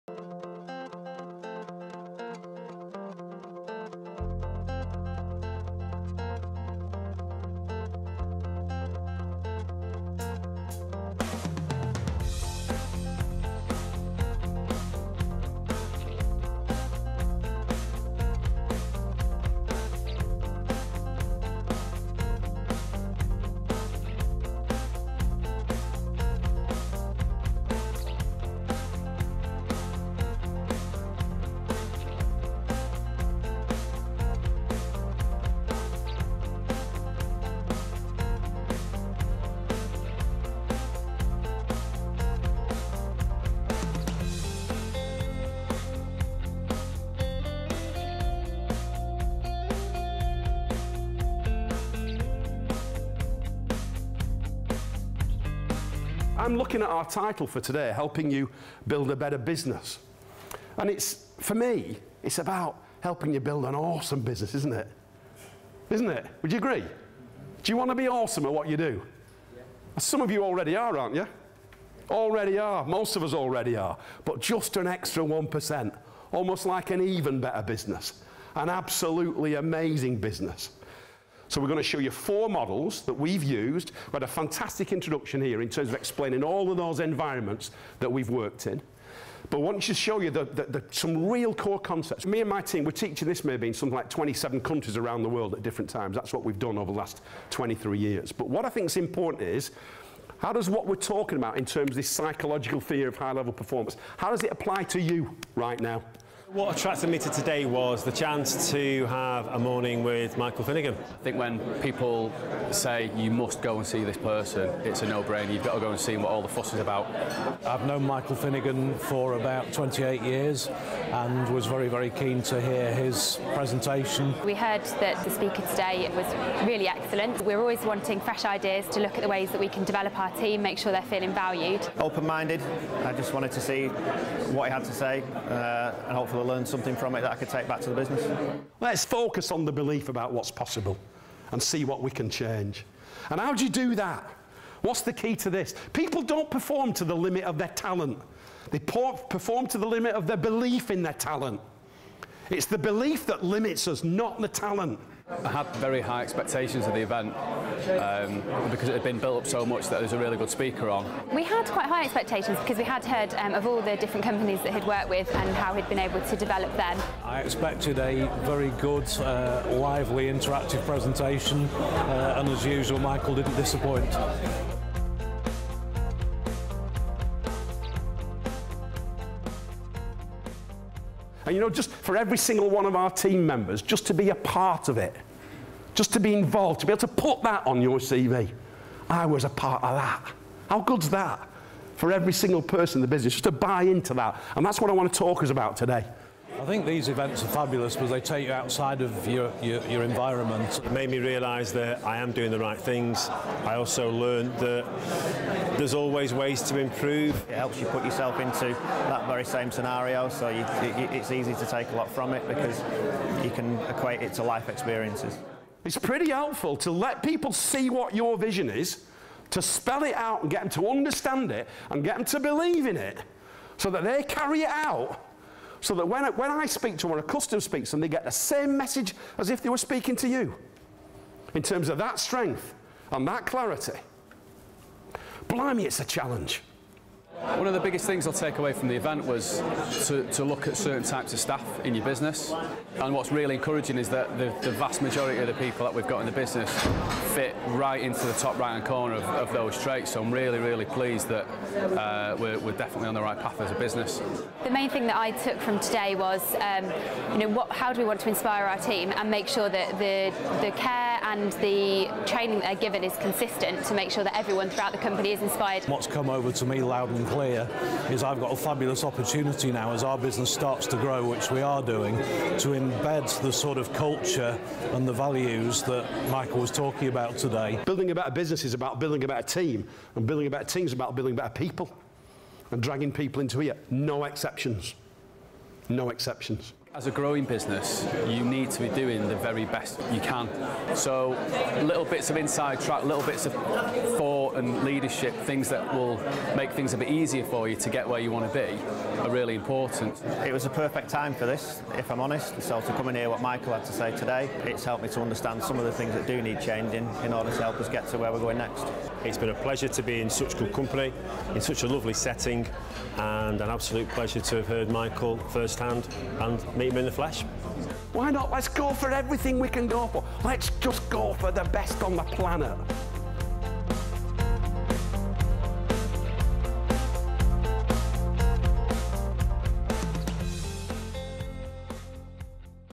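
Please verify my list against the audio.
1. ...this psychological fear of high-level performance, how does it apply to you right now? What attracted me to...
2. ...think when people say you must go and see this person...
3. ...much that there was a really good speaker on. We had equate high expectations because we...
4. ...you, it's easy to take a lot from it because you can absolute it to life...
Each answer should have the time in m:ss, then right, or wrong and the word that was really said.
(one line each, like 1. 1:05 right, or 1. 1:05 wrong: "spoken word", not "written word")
1. 1:41 right
2. 1:51 right
3. 2:39 wrong: "quite", not "equate"
4. 3:30 wrong: "equate", not "absolute".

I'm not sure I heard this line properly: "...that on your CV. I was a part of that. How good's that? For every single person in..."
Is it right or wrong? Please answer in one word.
right.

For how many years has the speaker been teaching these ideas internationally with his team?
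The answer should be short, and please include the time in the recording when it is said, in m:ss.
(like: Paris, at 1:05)
23, at 1:37.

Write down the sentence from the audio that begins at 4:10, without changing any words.
So I'm really, really pleased that uh, we're, we're definitely on the right path as a business.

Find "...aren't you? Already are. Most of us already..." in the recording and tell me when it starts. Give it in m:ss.
1:10.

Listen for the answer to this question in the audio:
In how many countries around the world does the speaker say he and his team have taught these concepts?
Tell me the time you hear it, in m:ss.
1:34.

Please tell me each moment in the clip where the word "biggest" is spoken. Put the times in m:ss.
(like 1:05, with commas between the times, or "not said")
3:57.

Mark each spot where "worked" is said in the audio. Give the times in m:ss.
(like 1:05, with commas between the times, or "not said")
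1:28, 2:44.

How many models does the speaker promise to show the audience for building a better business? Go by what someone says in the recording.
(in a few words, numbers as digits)
4.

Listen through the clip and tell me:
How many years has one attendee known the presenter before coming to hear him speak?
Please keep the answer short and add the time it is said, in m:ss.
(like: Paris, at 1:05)
28, at 1:59.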